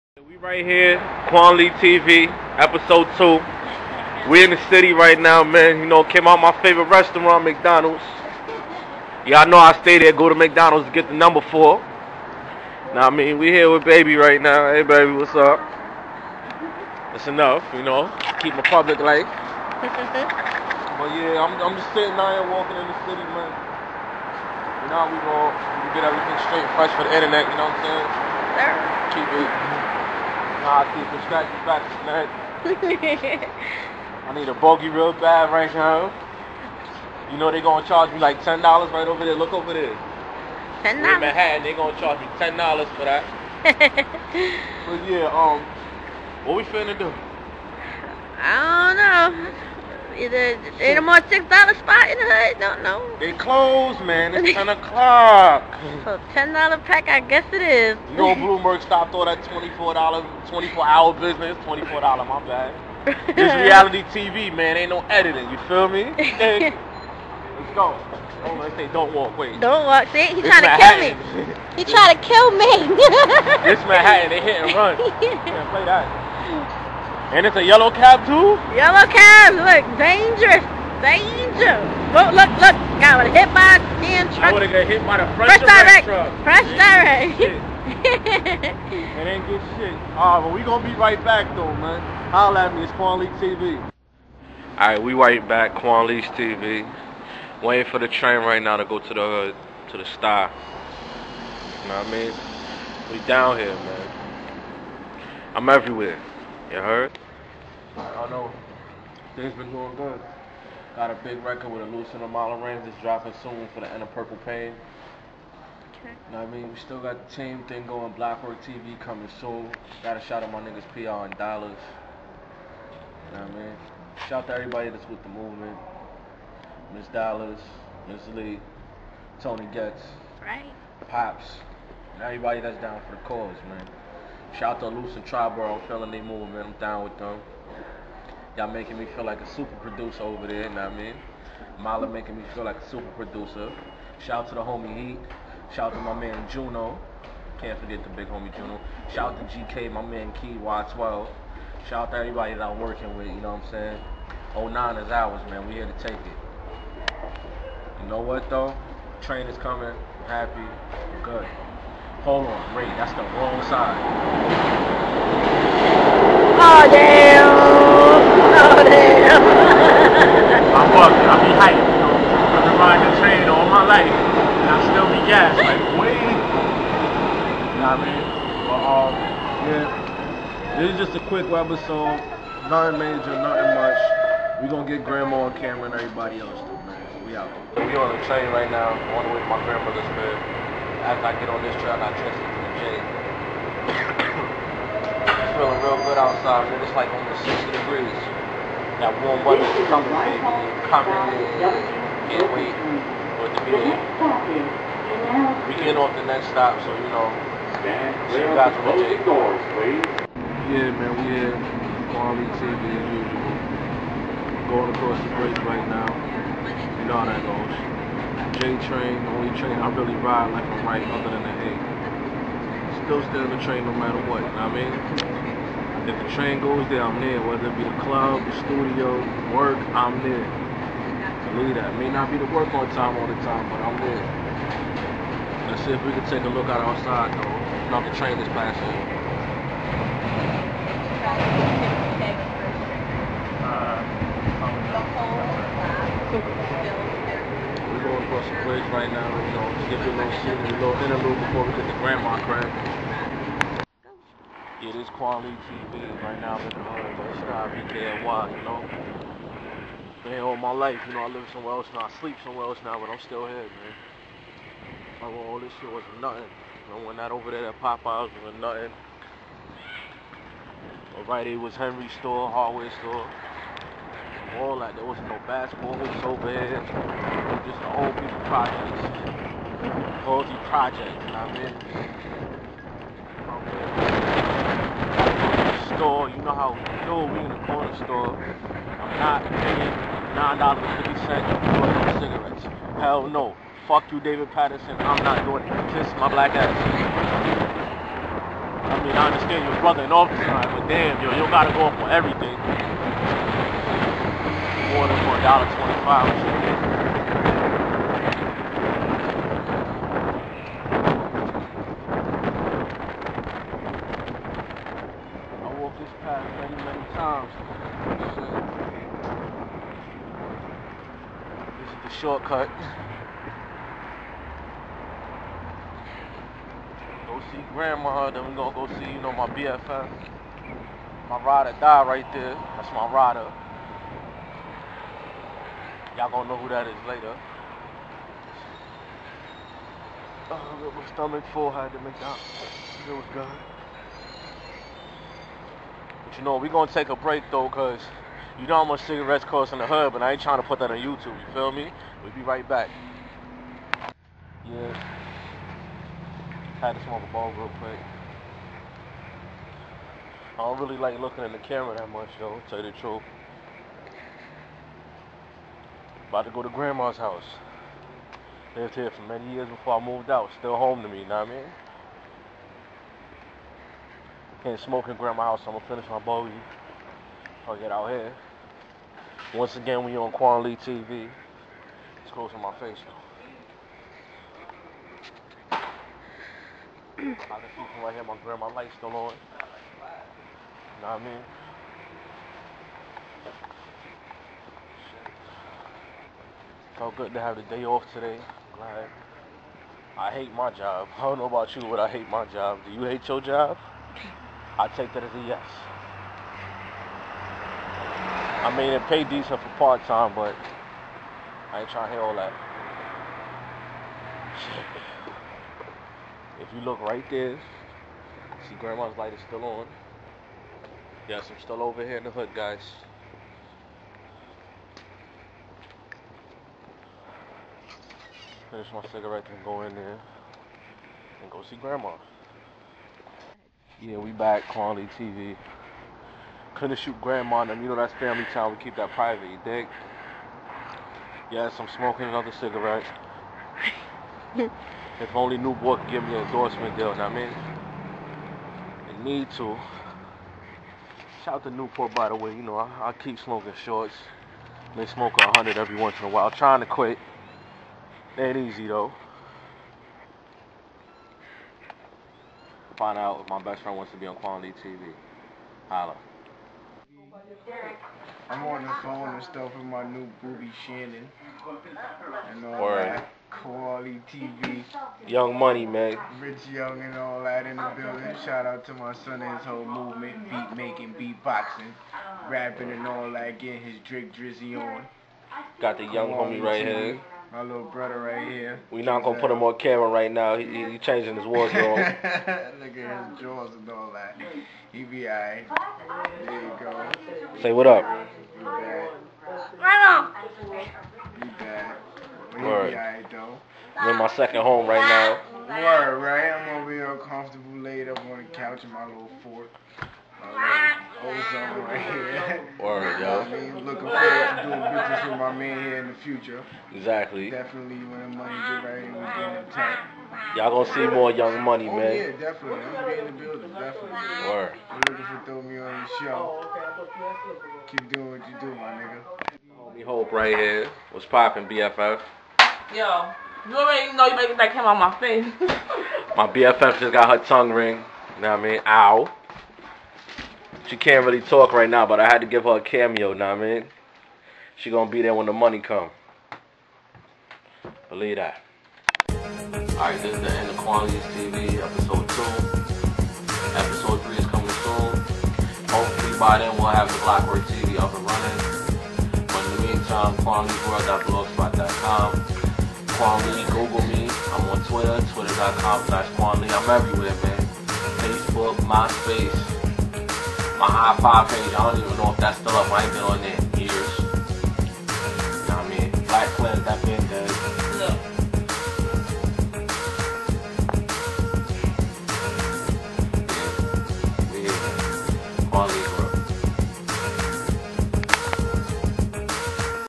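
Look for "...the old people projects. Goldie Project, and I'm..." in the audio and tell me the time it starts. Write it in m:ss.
4:37.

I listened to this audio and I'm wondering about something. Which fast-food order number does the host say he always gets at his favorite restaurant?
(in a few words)
4.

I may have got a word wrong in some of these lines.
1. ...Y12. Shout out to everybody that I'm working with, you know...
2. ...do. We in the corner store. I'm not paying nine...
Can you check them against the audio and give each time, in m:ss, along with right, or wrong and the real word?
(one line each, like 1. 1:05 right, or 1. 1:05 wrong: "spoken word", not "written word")
1. 2:30 right
2. 4:47 right.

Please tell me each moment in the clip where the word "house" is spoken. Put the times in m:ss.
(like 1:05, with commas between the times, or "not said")
6:07, 6:15.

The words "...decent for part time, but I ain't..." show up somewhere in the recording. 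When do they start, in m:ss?
6:49.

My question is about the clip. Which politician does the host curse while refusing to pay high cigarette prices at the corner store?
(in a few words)
David Paterson.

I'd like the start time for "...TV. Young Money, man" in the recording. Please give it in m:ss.
7:54.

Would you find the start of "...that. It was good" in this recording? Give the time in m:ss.
5:42.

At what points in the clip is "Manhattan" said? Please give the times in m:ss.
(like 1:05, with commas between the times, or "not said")
0:41, 1:13.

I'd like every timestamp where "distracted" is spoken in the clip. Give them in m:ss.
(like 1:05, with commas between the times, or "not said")
not said.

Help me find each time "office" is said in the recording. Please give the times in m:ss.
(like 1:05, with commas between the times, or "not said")
5:00.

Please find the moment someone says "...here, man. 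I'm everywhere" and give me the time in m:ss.
1:43.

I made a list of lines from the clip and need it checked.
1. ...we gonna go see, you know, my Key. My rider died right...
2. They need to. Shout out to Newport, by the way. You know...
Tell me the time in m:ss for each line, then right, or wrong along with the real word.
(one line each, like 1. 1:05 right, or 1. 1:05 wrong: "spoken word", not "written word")
1. 5:28 wrong: "BFF", not "Key"
2. 7:29 right.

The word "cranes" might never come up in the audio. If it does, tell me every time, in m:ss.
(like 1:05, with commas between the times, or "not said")
not said.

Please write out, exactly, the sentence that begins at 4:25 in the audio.
Like, well, all this shit was nothing.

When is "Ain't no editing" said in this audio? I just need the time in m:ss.
1:04.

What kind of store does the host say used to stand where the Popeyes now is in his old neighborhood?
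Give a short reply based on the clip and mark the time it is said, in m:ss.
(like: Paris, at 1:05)
Hardware store, at 4:32.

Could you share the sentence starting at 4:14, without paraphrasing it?
Yeah, this Kwan Lee TV right now, I'm in the hood, but it's not BKNY, you know?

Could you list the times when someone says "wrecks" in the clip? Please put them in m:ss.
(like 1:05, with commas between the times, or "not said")
not said.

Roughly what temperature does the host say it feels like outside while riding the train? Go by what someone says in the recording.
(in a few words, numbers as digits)
60 degrees.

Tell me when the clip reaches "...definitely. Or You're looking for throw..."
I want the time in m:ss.
8:43.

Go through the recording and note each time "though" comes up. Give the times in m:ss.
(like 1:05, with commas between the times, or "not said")
1:31, 2:38, 3:57, 5:47, 6:02, 6:25, 7:38, 8:23.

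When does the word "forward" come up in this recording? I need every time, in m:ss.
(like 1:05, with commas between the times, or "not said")
8:34.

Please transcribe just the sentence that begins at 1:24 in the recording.
I would have got hit by the fresh direct.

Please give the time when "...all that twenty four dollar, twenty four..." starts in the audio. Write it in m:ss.
0:59.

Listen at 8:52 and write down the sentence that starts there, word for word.
Yo, you already know you better get that camera on my face.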